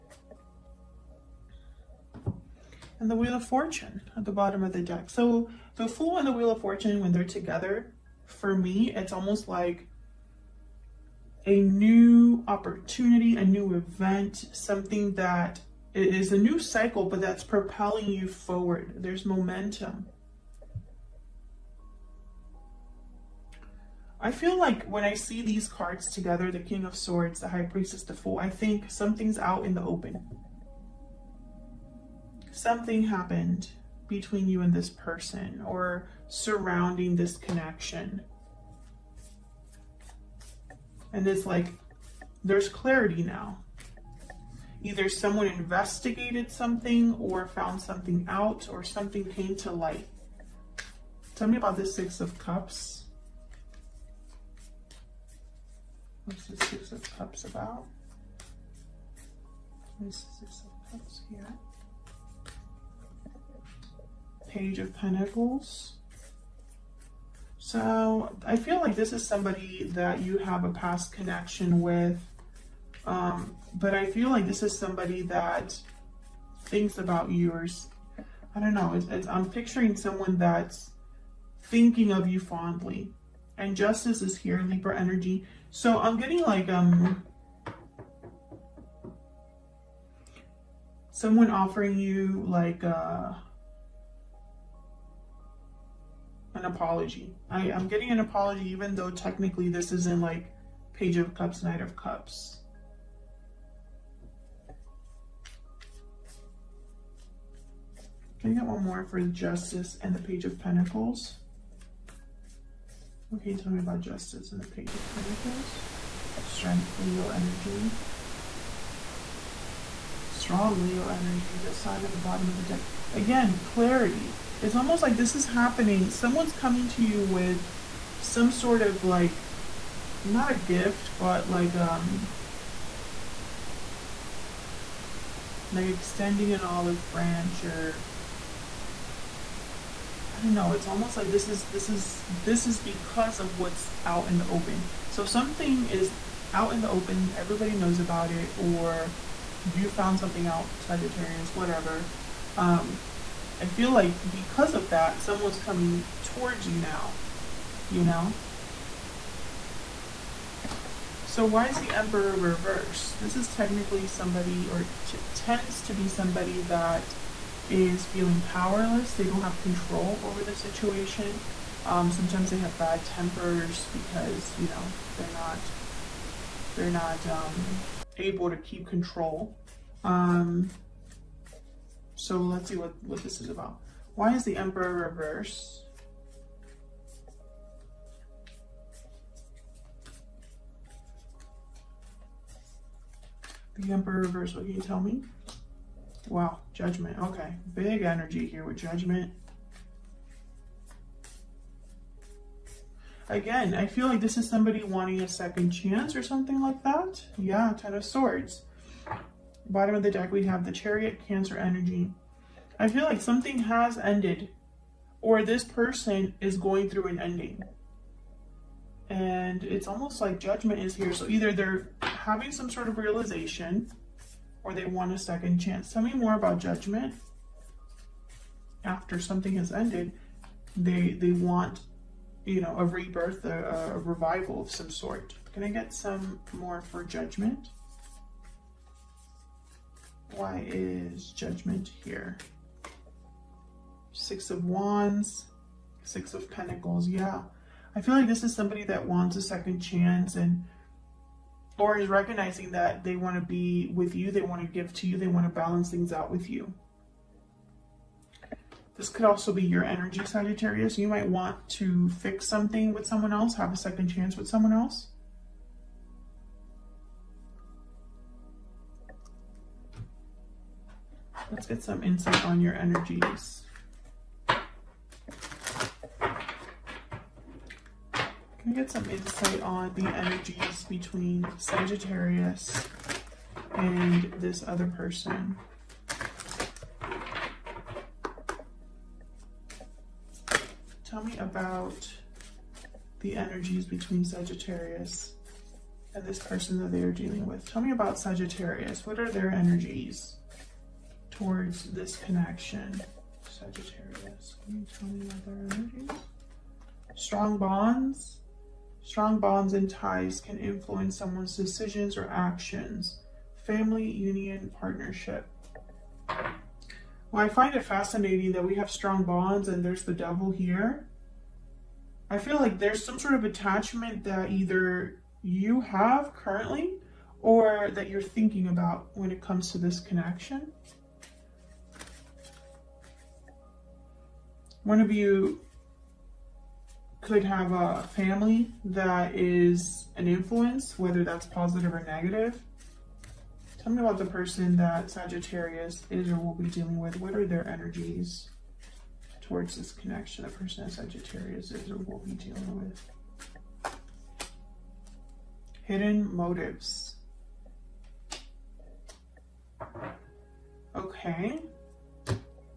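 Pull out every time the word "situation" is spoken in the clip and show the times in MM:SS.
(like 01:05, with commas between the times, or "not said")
02:50.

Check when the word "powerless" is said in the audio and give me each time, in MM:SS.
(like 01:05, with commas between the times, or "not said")
02:48.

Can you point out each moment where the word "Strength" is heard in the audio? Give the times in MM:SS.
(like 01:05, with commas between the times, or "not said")
01:56.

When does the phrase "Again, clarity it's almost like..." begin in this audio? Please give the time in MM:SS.
02:03.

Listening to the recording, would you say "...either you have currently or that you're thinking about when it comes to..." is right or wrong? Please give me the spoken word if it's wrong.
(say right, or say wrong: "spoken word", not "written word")
right.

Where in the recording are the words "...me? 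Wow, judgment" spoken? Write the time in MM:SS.
03:14.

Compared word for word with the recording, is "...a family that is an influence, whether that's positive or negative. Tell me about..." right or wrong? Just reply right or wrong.
right.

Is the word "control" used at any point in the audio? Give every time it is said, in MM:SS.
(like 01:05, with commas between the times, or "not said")
02:49, 02:58.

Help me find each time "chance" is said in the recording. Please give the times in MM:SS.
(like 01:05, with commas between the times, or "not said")
03:25, 03:45, 04:09, 04:24.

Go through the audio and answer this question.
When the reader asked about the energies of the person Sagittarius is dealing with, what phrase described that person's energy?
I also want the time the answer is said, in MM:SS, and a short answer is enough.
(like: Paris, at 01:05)
Hidden motives, at 05:55.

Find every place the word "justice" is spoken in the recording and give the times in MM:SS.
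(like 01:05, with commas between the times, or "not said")
01:23, 01:49, 01:54.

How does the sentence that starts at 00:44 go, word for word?
Either someone investigated something or found something out or something came to light.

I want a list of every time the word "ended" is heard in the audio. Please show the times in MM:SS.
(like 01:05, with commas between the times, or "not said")
03:33, 03:49.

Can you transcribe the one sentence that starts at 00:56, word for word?
What's the Six of Cups about?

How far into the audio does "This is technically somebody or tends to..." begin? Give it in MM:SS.
02:43.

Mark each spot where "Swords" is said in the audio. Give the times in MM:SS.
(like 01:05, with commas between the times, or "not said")
00:26, 03:28.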